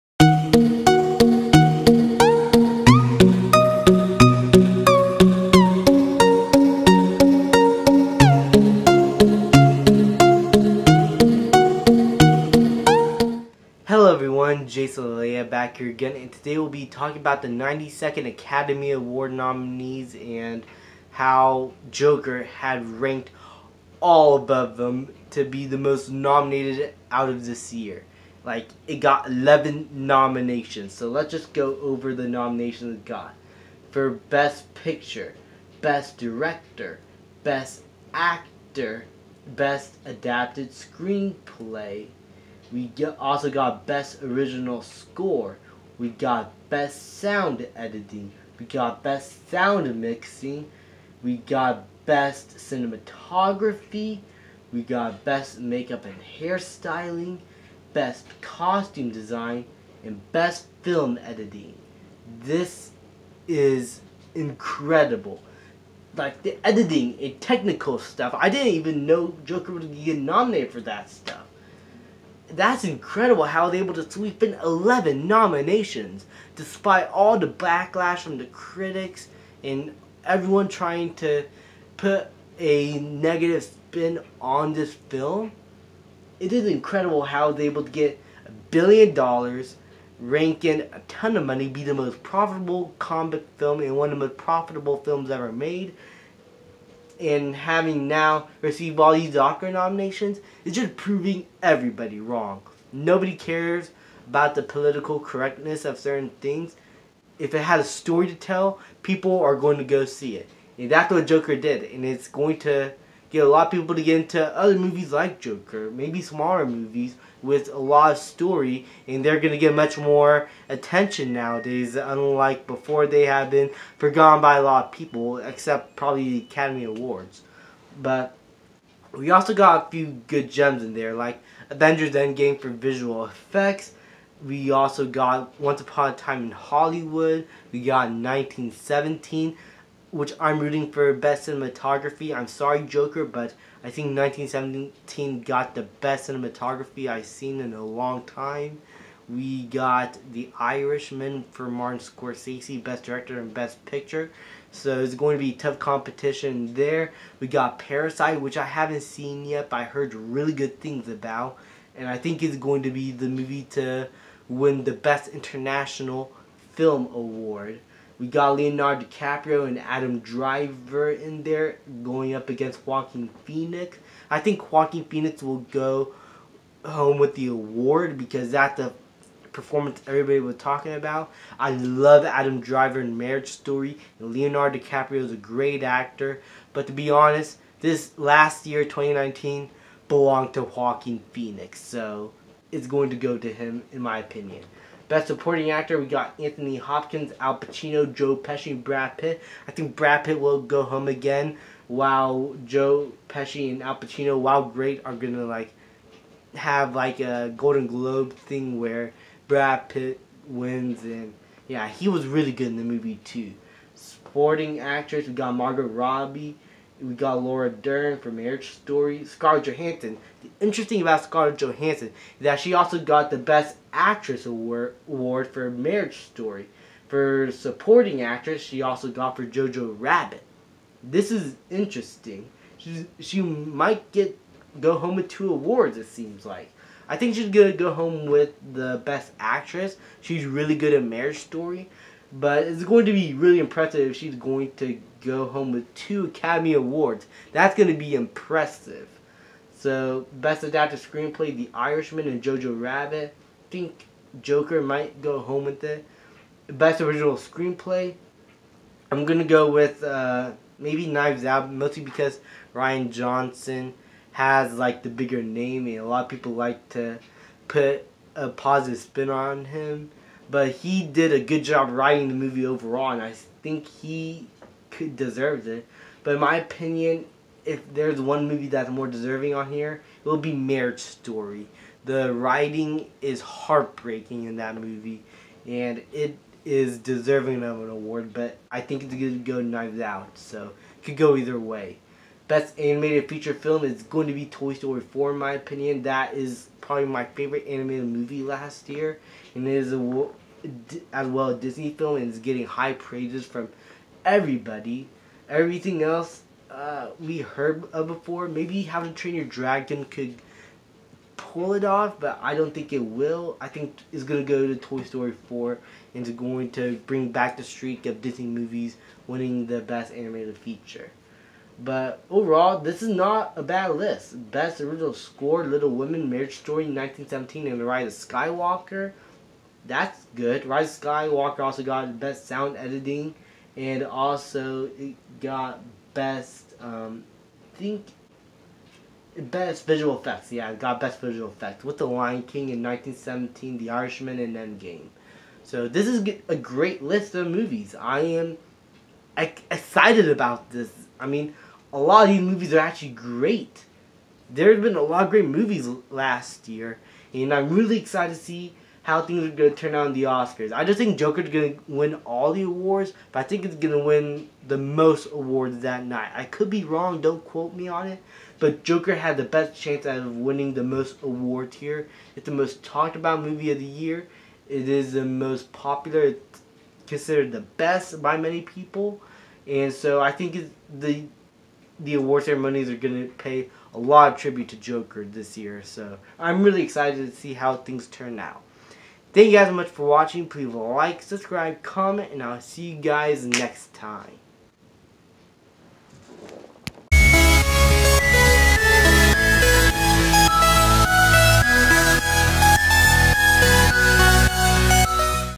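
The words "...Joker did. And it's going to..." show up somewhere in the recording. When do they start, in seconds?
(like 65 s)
111 s.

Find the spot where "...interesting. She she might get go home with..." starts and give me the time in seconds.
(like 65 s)
231 s.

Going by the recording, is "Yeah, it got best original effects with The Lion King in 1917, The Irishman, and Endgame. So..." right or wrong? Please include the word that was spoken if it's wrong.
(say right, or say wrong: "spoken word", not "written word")
wrong: "visual", not "original".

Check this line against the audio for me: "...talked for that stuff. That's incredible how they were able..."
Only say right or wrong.
wrong.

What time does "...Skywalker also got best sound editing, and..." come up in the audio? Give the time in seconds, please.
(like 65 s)
331 s.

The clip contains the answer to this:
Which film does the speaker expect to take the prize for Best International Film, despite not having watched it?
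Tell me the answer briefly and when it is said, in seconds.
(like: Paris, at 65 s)
Parasite, at 157 s.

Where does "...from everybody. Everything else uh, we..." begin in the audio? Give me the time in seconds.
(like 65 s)
303 s.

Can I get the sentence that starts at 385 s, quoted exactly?
So I'm really excited to see how things turn out.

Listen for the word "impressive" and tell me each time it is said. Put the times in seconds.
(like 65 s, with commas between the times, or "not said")
243 s, 248 s.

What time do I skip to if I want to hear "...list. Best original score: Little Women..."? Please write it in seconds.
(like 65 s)
323 s.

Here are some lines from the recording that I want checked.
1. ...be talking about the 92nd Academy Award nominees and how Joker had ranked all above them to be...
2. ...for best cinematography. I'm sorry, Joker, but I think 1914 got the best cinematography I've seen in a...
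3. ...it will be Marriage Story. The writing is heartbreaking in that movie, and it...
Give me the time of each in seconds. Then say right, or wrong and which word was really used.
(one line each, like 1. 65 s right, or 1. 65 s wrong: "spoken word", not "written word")
1. 16 s right
2. 140 s wrong: "1917", not "1914"
3. 280 s right.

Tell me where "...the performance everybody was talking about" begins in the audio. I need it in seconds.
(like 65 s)
178 s.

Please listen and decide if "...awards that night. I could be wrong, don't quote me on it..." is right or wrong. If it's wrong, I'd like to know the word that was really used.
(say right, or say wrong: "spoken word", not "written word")
right.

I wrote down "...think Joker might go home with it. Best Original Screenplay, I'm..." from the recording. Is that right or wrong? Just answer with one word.
right.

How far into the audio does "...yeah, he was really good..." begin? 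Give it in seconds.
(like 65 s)
211 s.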